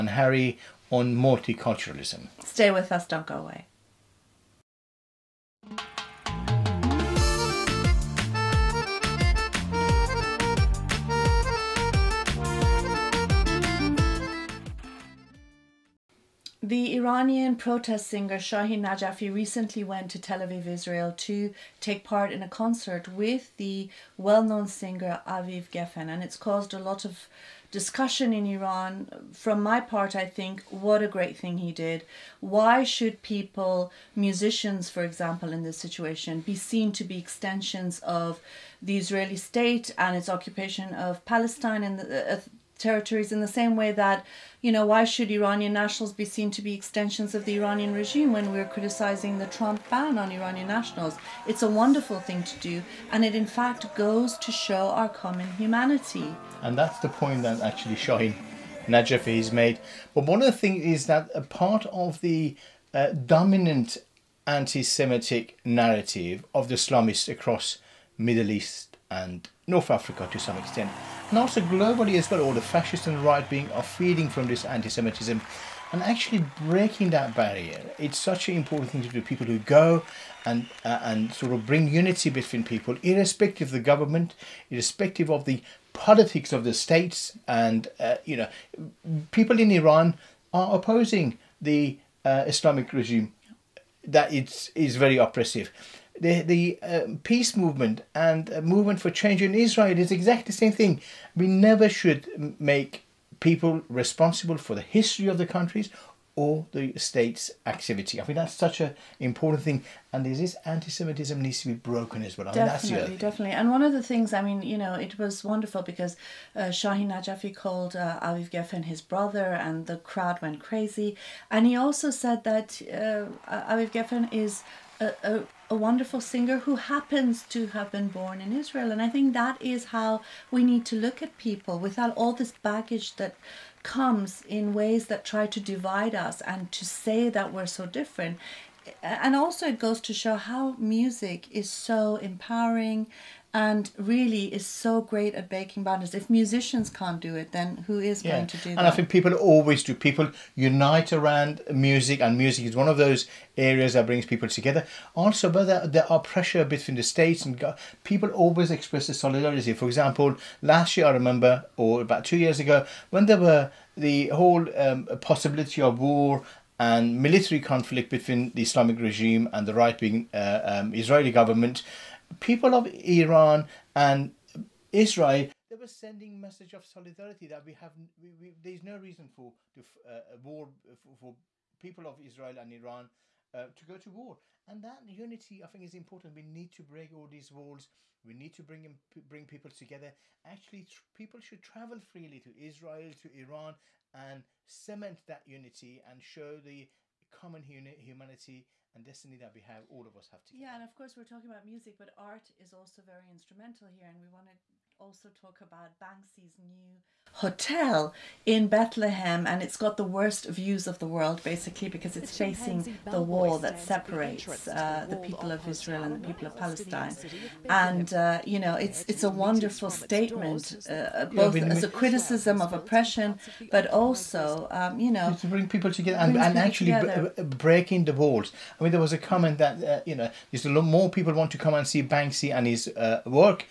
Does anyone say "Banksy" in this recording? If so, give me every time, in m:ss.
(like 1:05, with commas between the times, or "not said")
3:25, 3:52.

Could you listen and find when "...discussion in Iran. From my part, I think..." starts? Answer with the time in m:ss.
0:27.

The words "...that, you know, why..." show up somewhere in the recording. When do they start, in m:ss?
0:43.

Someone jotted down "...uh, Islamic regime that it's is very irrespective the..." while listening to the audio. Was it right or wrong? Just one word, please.
wrong.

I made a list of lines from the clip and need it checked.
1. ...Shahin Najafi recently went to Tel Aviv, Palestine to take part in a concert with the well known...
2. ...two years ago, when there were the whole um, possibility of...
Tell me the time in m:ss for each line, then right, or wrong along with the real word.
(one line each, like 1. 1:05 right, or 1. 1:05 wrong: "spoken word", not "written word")
1. 0:18 wrong: "Israel", not "Palestine"
2. 2:42 right.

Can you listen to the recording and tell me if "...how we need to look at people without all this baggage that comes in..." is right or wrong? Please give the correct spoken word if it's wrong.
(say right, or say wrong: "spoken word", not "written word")
right.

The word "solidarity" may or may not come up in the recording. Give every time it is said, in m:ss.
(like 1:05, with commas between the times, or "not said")
2:39, 2:56.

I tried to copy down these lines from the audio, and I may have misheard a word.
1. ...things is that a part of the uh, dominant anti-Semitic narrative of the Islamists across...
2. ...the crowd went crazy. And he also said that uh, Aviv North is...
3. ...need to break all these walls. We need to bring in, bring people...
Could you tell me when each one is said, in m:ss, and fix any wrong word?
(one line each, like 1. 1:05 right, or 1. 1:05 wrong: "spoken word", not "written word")
1. 1:00 right
2. 1:59 wrong: "Geffen", not "North"
3. 3:06 right.